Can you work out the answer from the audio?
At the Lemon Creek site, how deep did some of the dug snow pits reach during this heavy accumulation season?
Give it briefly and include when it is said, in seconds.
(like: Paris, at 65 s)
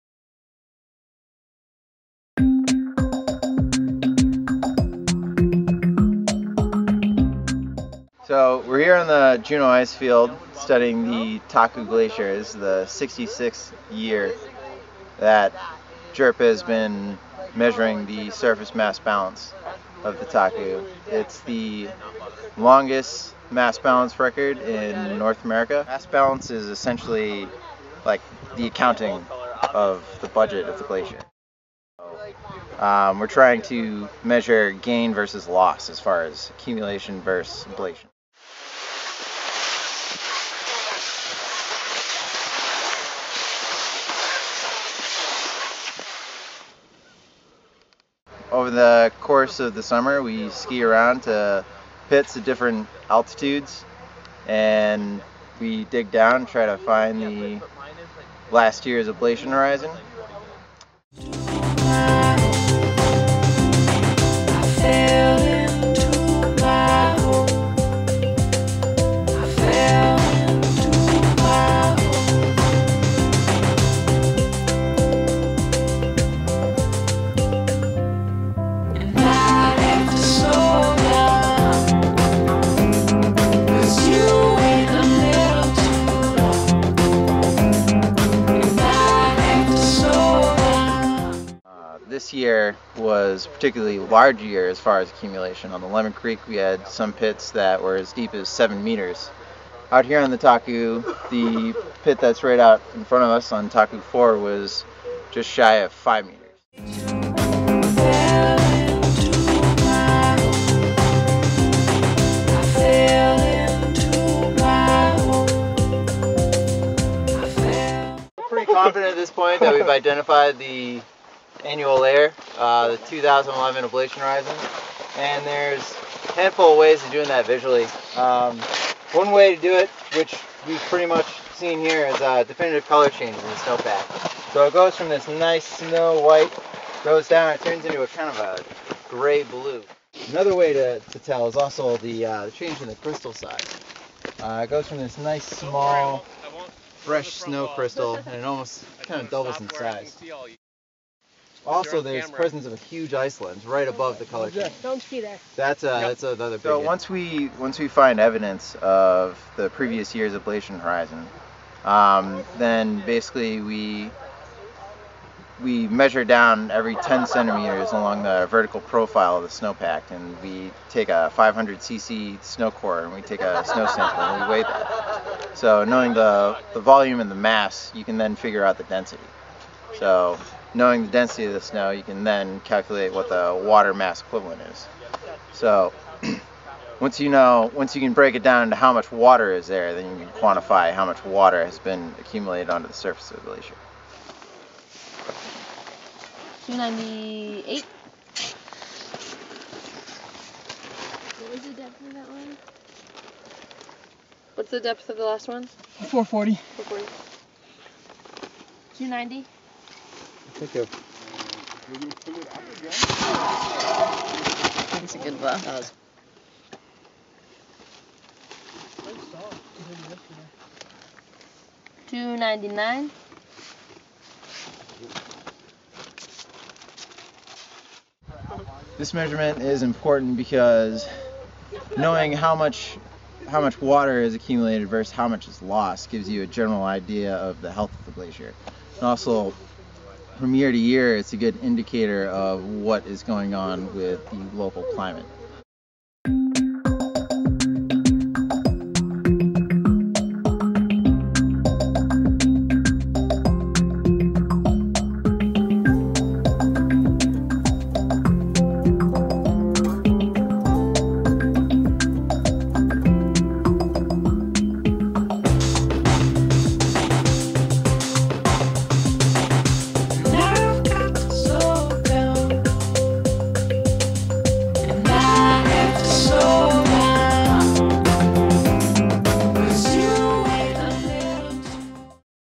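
7 meters, at 98 s.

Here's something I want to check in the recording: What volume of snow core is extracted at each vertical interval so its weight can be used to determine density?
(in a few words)
500 cc.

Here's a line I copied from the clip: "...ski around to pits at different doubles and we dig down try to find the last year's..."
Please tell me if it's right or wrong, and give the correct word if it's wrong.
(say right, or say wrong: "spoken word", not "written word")
wrong: "altitudes", not "doubles".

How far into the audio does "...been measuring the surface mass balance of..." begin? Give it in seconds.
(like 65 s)
16 s.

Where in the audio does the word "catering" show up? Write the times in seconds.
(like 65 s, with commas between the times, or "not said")
not said.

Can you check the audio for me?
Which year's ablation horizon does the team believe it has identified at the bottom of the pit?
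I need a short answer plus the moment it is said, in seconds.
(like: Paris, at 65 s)
2011, at 122 s.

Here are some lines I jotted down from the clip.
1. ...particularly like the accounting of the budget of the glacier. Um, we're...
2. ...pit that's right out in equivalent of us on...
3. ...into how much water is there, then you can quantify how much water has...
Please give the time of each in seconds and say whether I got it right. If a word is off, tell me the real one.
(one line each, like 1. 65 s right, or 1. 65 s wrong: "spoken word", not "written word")
1. 26 s wrong: "essentially", not "particularly"
2. 102 s wrong: "front", not "equivalent"
3. 188 s right.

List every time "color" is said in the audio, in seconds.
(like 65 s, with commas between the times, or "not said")
132 s, 154 s.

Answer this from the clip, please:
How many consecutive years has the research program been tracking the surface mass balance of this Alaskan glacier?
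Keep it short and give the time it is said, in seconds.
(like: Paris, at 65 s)
66, at 12 s.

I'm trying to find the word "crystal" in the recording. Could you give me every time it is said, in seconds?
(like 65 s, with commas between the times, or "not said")
142 s, 147 s.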